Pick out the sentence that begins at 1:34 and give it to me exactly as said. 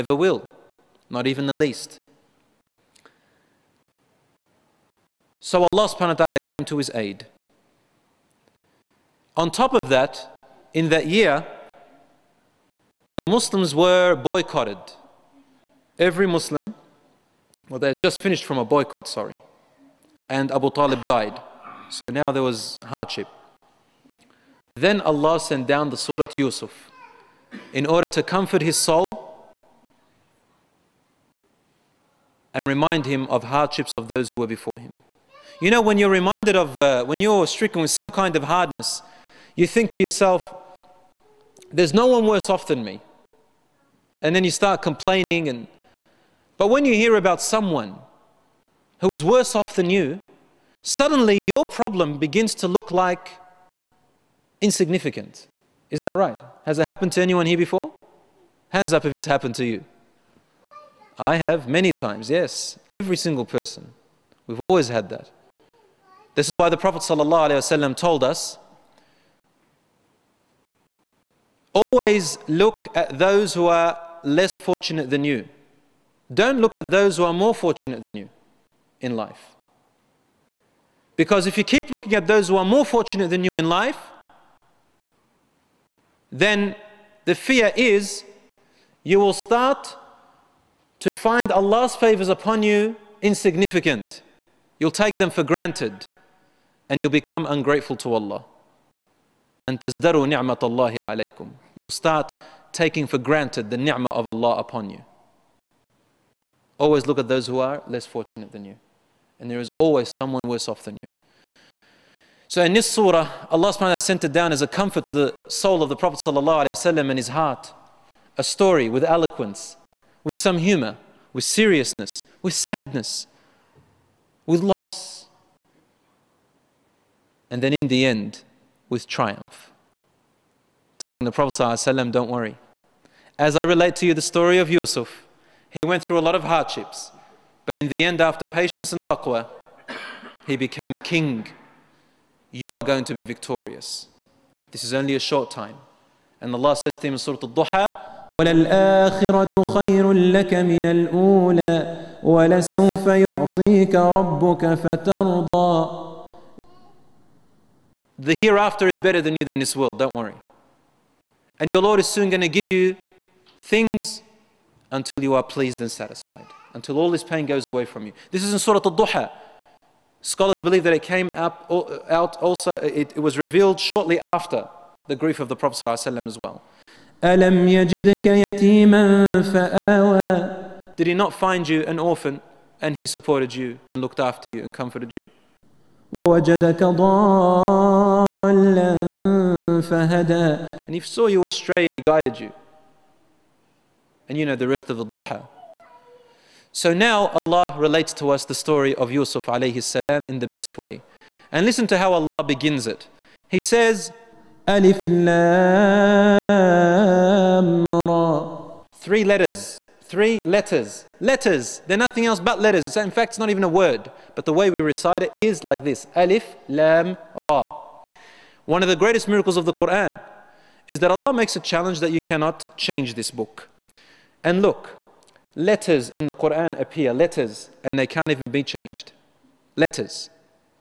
You'll take them for granted and you'll become ungrateful to Allah and tazdaru ni'matallahi alaykum.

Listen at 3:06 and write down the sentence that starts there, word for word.
ووجدك ضالا فهدى And he saw you astray and he guided you.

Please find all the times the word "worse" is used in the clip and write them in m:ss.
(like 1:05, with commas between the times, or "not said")
0:42, 0:49, 1:50.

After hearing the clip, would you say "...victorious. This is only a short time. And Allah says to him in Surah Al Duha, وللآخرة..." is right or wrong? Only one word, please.
right.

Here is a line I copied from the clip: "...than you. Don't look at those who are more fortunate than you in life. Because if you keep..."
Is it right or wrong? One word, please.
right.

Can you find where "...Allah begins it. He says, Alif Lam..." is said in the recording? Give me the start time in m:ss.
3:22.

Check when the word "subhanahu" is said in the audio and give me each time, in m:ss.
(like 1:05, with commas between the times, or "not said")
0:05, 1:53.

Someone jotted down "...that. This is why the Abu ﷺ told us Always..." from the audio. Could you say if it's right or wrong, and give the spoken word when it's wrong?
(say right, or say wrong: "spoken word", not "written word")
wrong: "Prophet", not "Abu".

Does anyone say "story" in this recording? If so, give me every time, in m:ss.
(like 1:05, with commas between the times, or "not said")
1:58, 2:14, 3:18.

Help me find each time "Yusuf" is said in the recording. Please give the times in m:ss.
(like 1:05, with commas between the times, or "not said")
0:26, 2:14, 3:19.